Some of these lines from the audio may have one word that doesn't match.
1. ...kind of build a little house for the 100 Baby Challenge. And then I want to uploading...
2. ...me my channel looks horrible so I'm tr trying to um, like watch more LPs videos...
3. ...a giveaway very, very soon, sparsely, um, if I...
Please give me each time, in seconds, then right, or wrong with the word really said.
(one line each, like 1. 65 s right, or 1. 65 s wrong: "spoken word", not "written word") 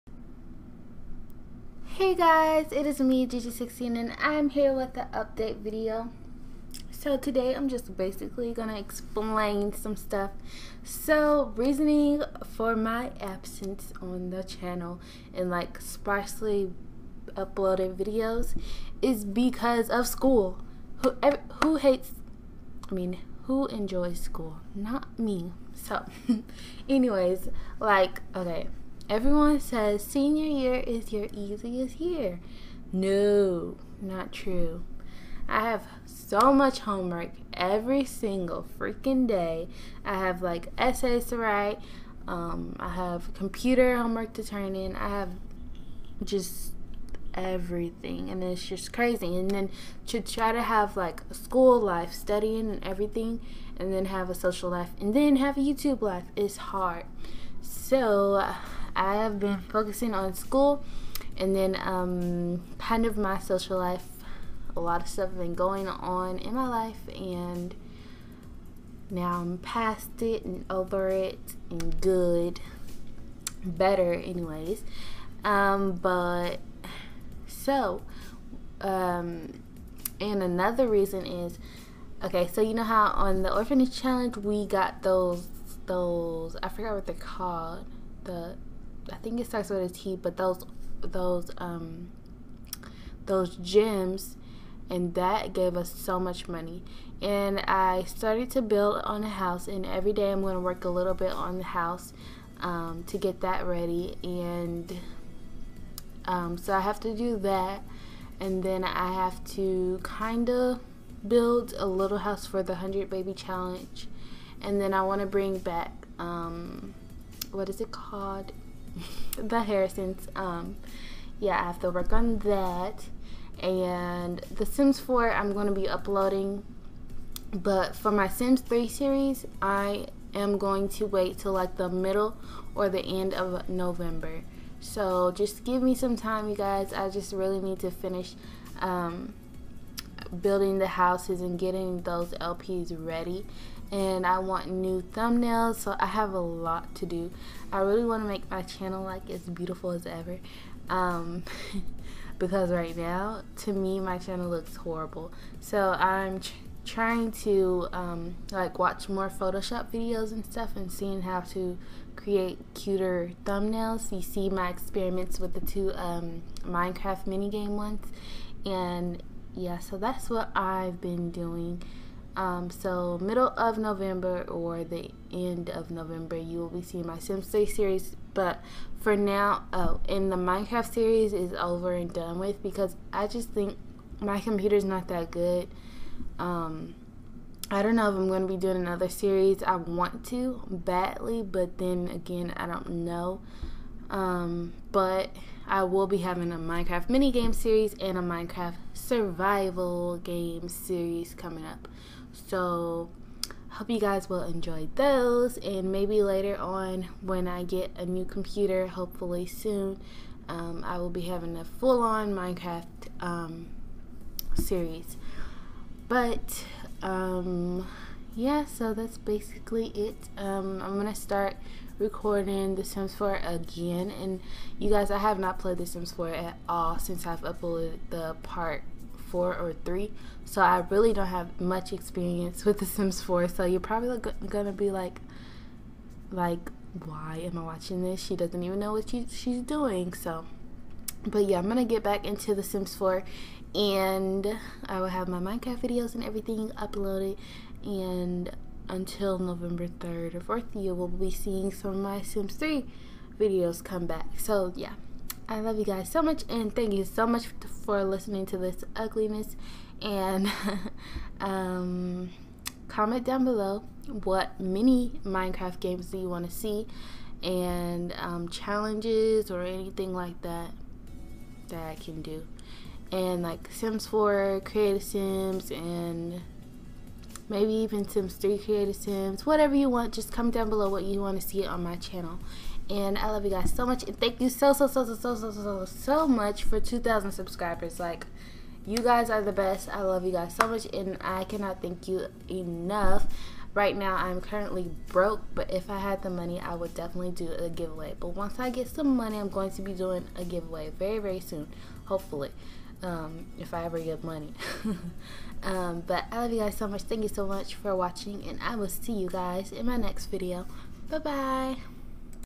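1. 110 s wrong: "bring", not "uploading"
2. 153 s wrong: "Photoshop", not "LPs"
3. 300 s wrong: "hopefully", not "sparsely".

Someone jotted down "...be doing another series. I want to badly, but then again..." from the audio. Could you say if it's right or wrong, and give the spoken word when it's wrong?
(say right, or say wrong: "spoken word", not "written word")
right.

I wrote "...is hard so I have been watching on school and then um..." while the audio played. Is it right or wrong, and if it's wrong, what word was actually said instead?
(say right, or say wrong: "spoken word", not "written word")
wrong: "focusing", not "watching".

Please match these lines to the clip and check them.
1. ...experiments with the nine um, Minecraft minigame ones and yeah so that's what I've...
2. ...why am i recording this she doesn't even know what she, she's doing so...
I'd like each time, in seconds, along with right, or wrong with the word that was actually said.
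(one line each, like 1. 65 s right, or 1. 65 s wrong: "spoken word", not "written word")
1. 164 s wrong: "two", not "nine"
2. 237 s wrong: "watching", not "recording".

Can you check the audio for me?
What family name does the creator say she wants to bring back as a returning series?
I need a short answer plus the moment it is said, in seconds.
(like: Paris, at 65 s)
the Harrisons, at 119 s.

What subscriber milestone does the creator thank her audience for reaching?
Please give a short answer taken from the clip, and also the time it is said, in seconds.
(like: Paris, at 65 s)
2,000, at 286 s.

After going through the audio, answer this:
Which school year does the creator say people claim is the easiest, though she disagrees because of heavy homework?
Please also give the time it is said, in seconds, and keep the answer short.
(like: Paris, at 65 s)
Senior year, at 30 s.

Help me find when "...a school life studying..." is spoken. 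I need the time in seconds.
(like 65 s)
51 s.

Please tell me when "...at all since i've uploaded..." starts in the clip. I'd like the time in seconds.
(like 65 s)
226 s.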